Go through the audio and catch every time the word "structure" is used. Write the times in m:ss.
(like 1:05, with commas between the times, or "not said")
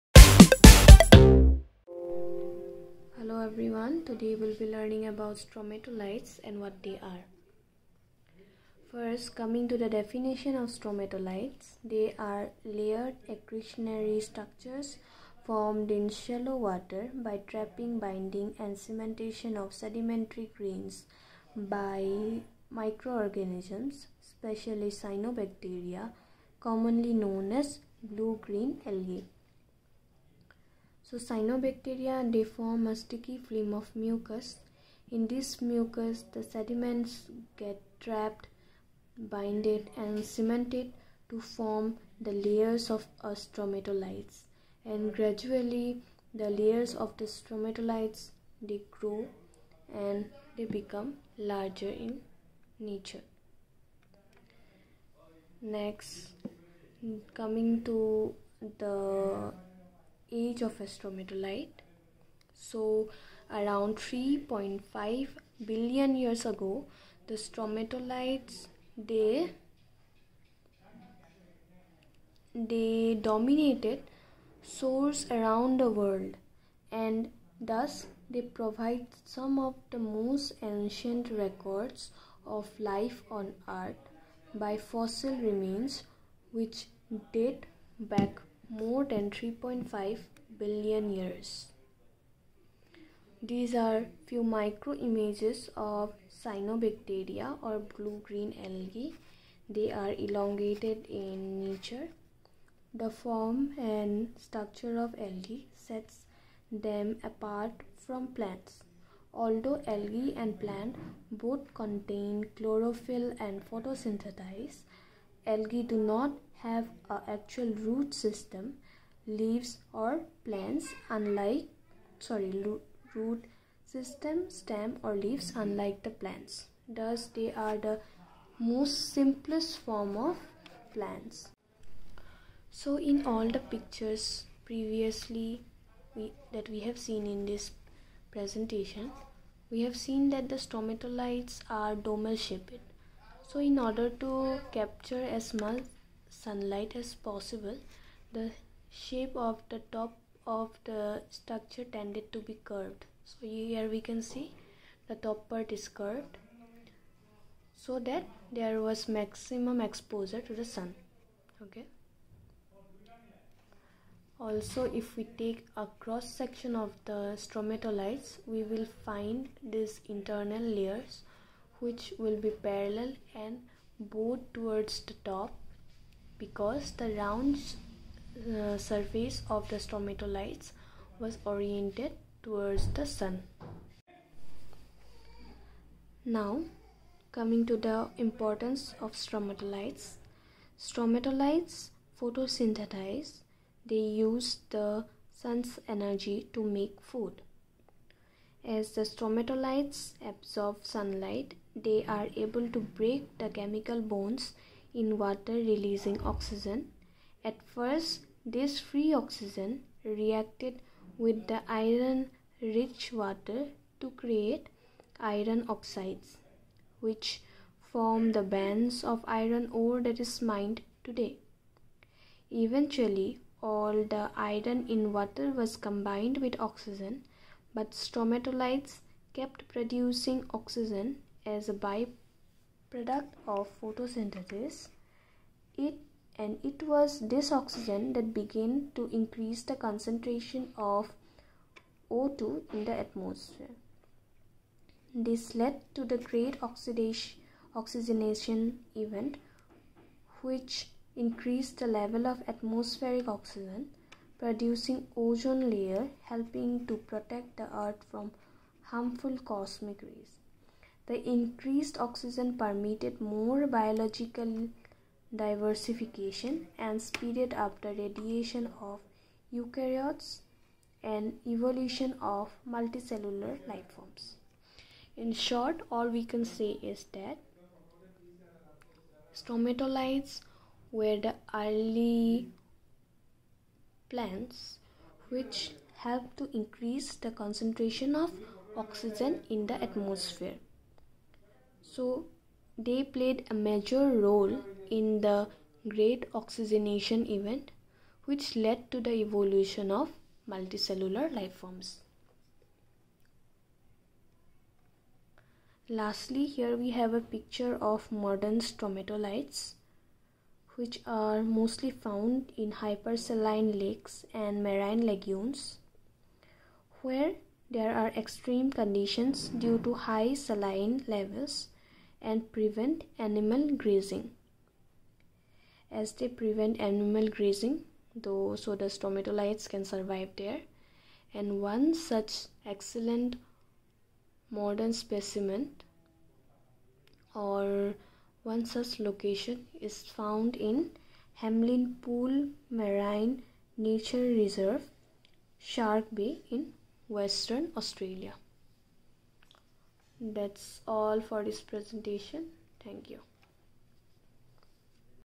0:14, 1:44, 2:31.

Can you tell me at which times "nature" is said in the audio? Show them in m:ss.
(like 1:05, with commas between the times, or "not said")
0:52, 1:41, 5:43.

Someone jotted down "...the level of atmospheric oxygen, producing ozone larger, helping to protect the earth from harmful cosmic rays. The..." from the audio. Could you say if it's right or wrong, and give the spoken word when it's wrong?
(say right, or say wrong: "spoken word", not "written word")
wrong: "layer", not "larger".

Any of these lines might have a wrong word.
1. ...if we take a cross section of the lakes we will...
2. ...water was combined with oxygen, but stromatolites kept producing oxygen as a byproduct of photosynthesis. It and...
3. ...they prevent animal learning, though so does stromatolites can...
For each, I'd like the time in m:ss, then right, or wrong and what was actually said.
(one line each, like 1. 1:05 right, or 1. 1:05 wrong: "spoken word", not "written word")
1. 2:45 wrong: "stromatolites", not "lakes"
2. 3:45 right
3. 5:26 wrong: "grazing", not "learning".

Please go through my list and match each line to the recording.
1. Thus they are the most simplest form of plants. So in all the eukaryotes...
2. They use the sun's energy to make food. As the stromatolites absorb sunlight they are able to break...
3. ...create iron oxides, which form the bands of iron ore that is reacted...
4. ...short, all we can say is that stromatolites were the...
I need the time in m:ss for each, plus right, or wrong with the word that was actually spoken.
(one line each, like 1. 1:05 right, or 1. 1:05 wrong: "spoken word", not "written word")
1. 2:06 wrong: "pictures", not "eukaryotes"
2. 3:13 right
3. 3:34 wrong: "mined", not "reacted"
4. 4:35 right.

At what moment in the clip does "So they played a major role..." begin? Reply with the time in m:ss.
4:51.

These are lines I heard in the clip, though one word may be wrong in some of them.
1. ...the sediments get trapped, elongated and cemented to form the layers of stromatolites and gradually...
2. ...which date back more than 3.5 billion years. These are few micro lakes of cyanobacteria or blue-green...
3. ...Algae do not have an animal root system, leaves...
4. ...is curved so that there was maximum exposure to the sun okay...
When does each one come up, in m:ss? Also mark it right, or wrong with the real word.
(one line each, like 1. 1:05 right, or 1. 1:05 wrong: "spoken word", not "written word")
1. 0:36 wrong: "binded", not "elongated"
2. 1:26 wrong: "images", not "lakes"
3. 1:55 wrong: "actual", not "animal"
4. 2:35 right.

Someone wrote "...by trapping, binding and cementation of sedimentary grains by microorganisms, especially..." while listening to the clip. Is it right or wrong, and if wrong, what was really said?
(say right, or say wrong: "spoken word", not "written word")
right.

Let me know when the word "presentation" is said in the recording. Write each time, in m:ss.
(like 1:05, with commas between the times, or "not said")
2:18, 5:51.